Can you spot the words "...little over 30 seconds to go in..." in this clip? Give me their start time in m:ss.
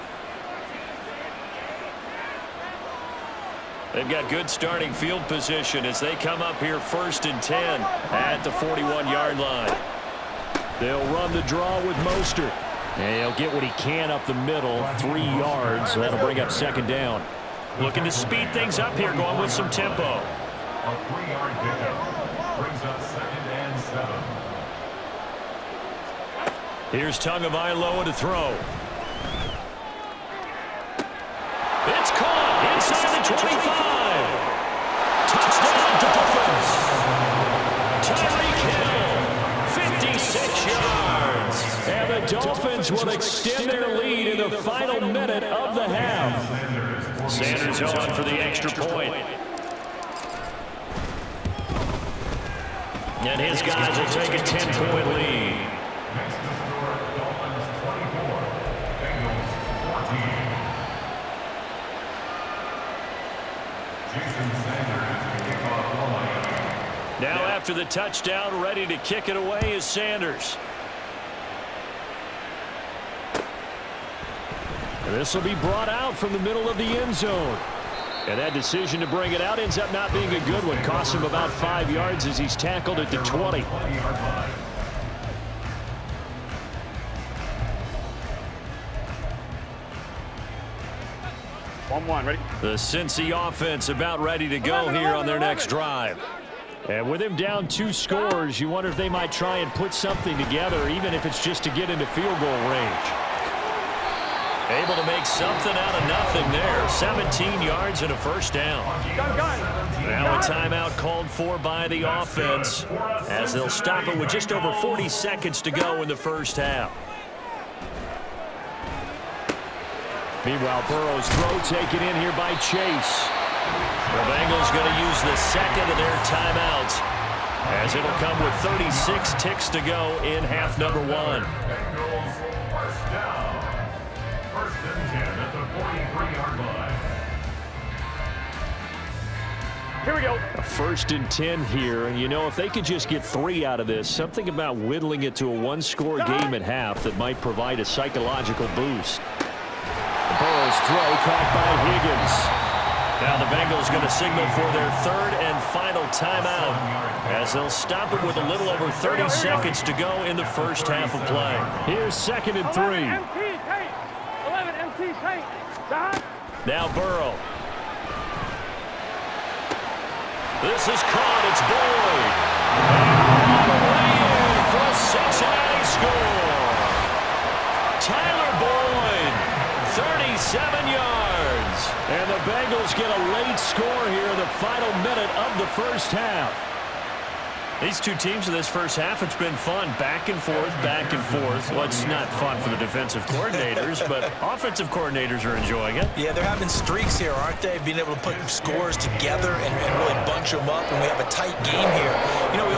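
2:38.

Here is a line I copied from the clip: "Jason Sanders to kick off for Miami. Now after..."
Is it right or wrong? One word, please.
right.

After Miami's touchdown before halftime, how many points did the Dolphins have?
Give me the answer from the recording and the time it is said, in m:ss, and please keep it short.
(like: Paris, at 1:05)
24, at 0:57.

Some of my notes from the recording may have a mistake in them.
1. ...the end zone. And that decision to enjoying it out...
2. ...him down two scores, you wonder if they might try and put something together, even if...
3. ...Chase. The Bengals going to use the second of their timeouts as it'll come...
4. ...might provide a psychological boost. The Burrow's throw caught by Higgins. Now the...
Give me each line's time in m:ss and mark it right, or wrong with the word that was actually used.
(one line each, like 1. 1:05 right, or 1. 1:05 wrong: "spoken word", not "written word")
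1. 1:16 wrong: "bring", not "enjoying"
2. 1:37 right
3. 2:02 right
4. 2:27 right.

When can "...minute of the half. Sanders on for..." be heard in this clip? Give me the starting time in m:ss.
0:45.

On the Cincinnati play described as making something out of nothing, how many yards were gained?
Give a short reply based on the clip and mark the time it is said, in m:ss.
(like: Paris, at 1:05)
17, at 1:46.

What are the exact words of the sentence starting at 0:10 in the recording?
They'll run the draw with Mostert.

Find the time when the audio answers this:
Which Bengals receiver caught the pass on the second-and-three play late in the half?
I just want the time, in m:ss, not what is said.
2:53.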